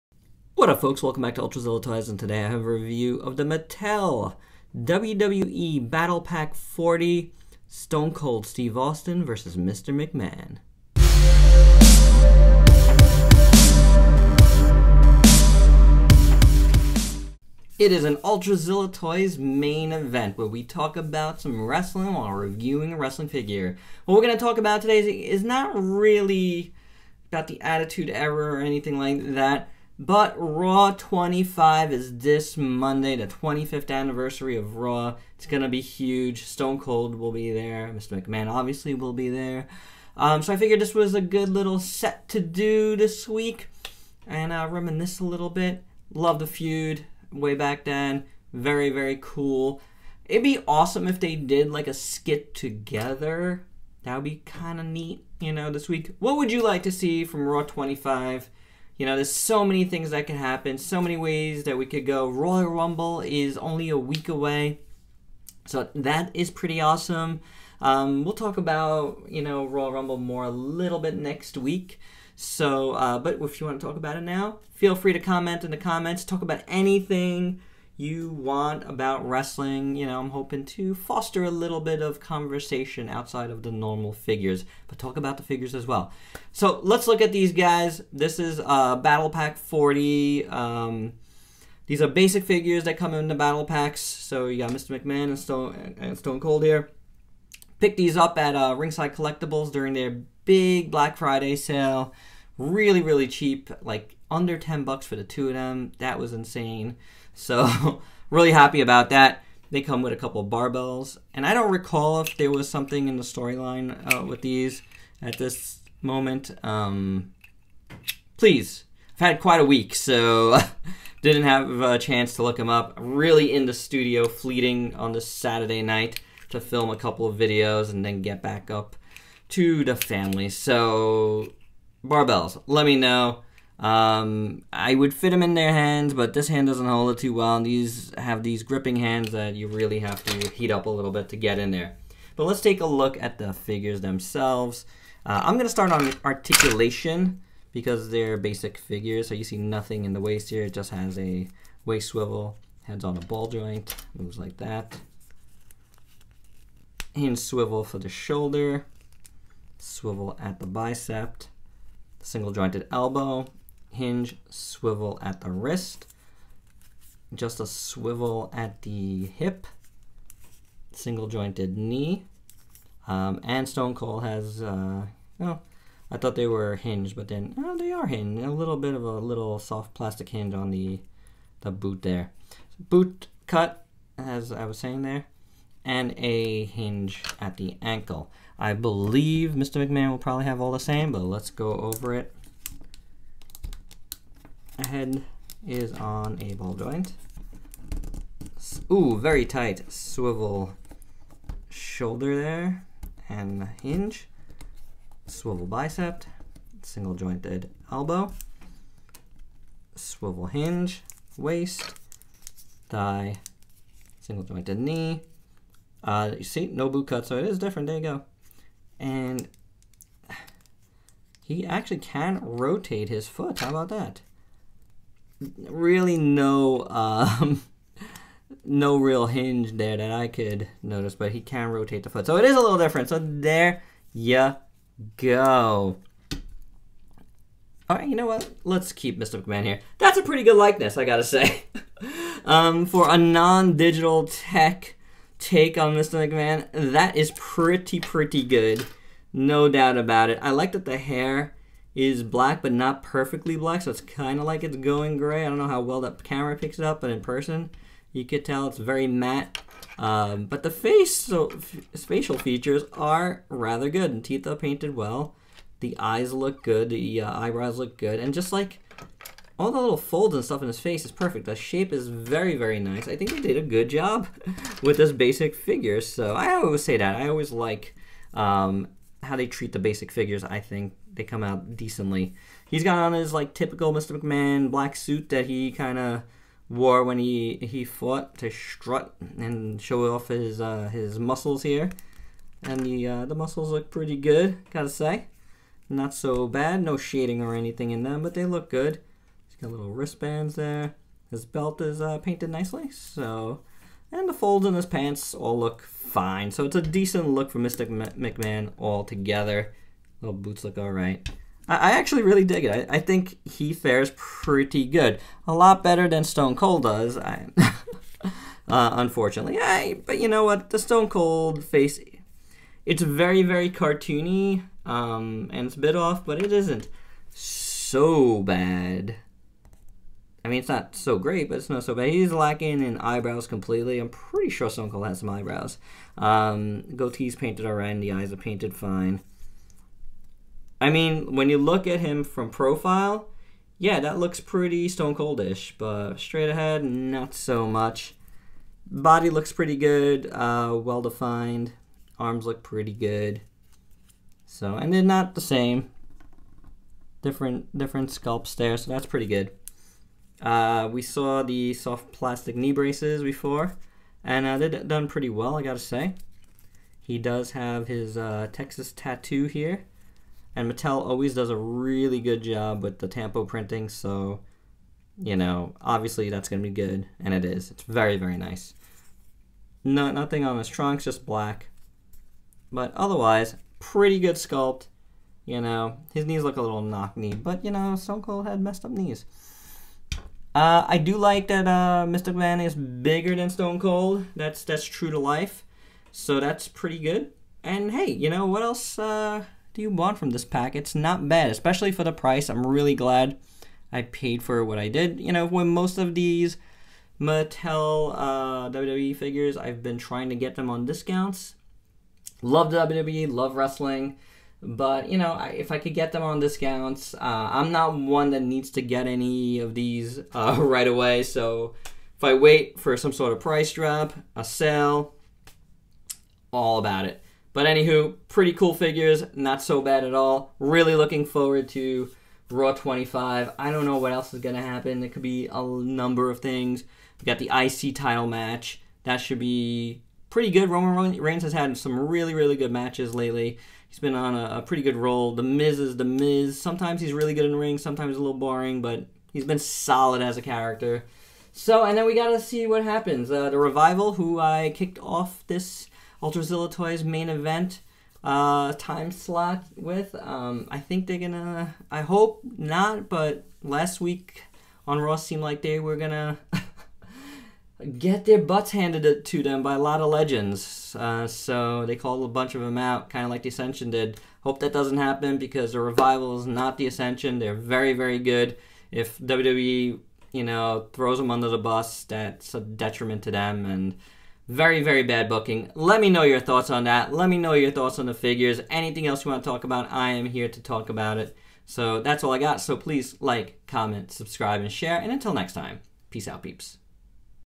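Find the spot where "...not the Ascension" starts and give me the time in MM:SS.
07:56.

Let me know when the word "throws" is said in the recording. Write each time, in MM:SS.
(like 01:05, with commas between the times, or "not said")
08:00.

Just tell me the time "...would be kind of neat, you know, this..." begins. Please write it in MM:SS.
00:54.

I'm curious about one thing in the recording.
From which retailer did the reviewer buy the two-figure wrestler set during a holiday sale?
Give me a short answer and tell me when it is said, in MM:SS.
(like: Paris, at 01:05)
Ringside Collectibles, at 01:38.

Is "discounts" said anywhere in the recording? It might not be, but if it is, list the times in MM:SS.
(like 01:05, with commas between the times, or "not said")
06:50, 06:56.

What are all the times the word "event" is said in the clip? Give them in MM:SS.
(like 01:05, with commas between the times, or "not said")
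00:19, 07:37.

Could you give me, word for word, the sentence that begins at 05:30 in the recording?
I mean, it's not so great, but it's not so bad.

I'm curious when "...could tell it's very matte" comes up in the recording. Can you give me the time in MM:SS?
04:18.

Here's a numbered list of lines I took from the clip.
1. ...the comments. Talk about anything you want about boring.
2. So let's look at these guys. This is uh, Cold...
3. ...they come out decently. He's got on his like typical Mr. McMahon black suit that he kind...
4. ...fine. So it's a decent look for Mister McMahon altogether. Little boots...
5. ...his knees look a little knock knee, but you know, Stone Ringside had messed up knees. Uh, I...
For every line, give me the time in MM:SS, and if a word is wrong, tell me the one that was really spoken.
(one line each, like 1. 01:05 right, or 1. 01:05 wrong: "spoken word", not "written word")
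1. 01:15 wrong: "wrestling", not "boring"
2. 01:26 wrong: "Battle", not "Cold"
3. 04:41 right
4. 05:05 right
5. 06:26 wrong: "Cold", not "Ringside".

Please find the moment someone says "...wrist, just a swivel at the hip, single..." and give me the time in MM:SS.
02:45.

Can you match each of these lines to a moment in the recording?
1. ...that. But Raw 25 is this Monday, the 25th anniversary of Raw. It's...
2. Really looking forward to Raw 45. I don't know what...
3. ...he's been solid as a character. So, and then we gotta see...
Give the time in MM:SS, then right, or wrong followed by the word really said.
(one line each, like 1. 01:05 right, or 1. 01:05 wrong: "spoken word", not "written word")
1. 00:29 right
2. 07:10 wrong: "25", not "45"
3. 07:29 right.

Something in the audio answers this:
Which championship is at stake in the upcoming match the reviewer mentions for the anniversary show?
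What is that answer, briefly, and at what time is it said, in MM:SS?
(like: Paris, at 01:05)
IC title, at 07:17.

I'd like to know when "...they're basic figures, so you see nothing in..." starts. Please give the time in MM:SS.
02:28.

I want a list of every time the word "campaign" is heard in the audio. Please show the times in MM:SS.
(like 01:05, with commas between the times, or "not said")
not said.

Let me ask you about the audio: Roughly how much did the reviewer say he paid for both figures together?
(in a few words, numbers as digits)
under $10.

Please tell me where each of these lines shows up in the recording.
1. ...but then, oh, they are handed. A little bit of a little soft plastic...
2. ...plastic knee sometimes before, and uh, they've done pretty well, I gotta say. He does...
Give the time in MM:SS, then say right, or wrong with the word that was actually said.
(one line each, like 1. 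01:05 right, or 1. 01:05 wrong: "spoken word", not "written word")
1. 02:57 wrong: "hinged", not "handed"
2. 06:02 wrong: "braces", not "sometimes".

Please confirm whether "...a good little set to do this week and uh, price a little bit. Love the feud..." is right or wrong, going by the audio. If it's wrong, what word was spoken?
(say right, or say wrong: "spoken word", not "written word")
wrong: "reminisce", not "price".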